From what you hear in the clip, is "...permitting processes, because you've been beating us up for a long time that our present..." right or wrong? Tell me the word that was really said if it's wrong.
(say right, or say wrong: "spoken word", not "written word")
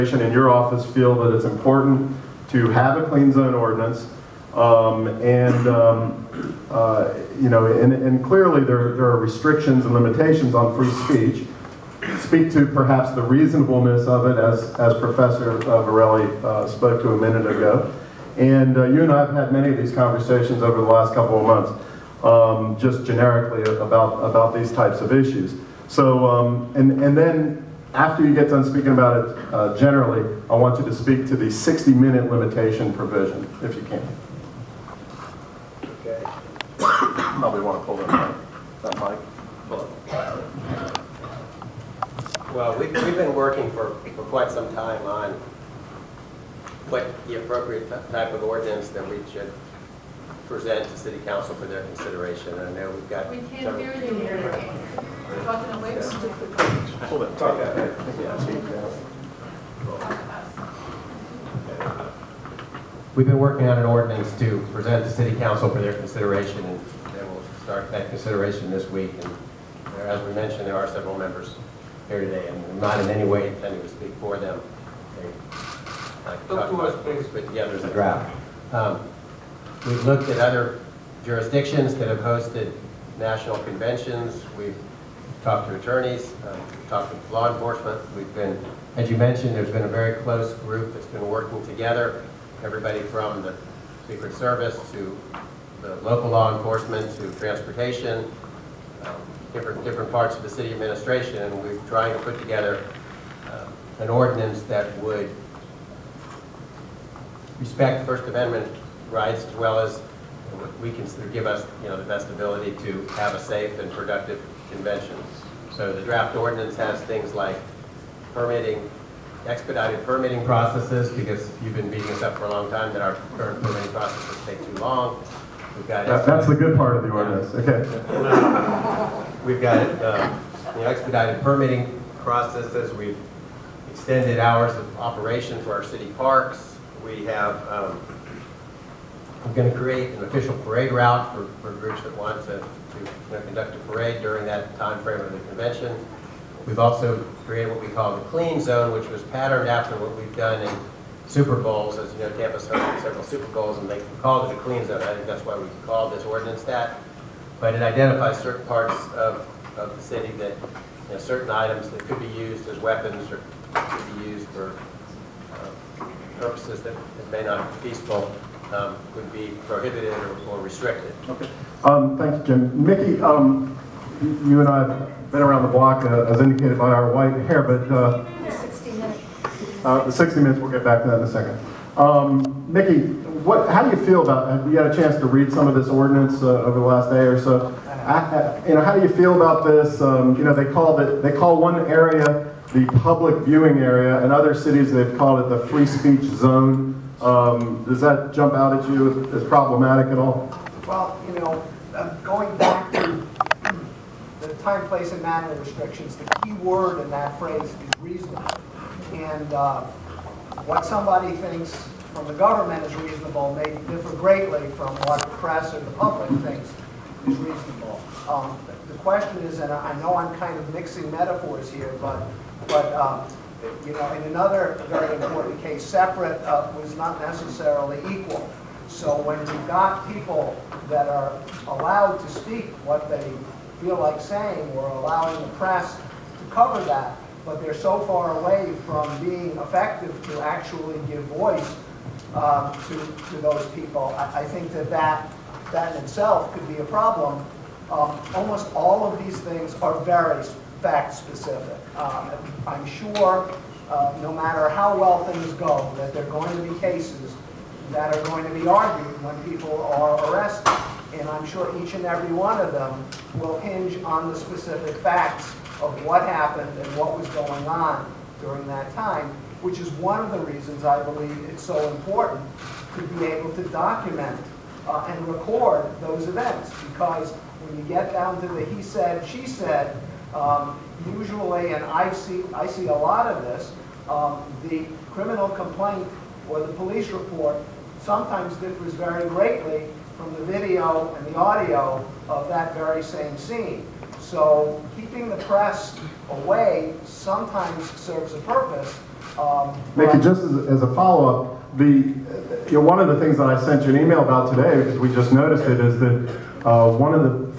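wrong: "current", not "present".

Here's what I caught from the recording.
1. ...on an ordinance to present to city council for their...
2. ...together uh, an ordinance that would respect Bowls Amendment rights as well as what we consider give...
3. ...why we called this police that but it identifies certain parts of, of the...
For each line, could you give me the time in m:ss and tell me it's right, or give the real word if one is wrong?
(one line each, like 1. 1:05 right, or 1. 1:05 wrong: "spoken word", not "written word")
1. 1:03 right
2. 1:42 wrong: "First", not "Bowls"
3. 2:35 wrong: "ordinance", not "police".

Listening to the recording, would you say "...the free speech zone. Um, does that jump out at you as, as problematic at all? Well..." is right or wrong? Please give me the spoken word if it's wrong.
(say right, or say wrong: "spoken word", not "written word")
right.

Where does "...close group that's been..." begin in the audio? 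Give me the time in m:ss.
1:30.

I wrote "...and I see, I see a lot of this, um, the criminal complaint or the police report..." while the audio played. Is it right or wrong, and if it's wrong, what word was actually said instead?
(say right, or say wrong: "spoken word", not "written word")
right.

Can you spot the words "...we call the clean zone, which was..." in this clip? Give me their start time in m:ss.
2:27.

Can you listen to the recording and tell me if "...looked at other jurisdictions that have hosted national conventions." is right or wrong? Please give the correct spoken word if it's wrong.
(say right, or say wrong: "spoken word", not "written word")
right.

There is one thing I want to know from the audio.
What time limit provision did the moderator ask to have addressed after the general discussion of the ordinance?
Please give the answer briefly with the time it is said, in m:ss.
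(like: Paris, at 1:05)
60-minute limitation, at 0:31.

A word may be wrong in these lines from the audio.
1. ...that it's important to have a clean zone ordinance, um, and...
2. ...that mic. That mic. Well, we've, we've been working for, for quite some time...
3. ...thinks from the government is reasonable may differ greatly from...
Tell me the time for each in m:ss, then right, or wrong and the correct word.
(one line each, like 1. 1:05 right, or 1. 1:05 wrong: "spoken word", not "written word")
1. 0:01 right
2. 0:37 right
3. 3:31 right.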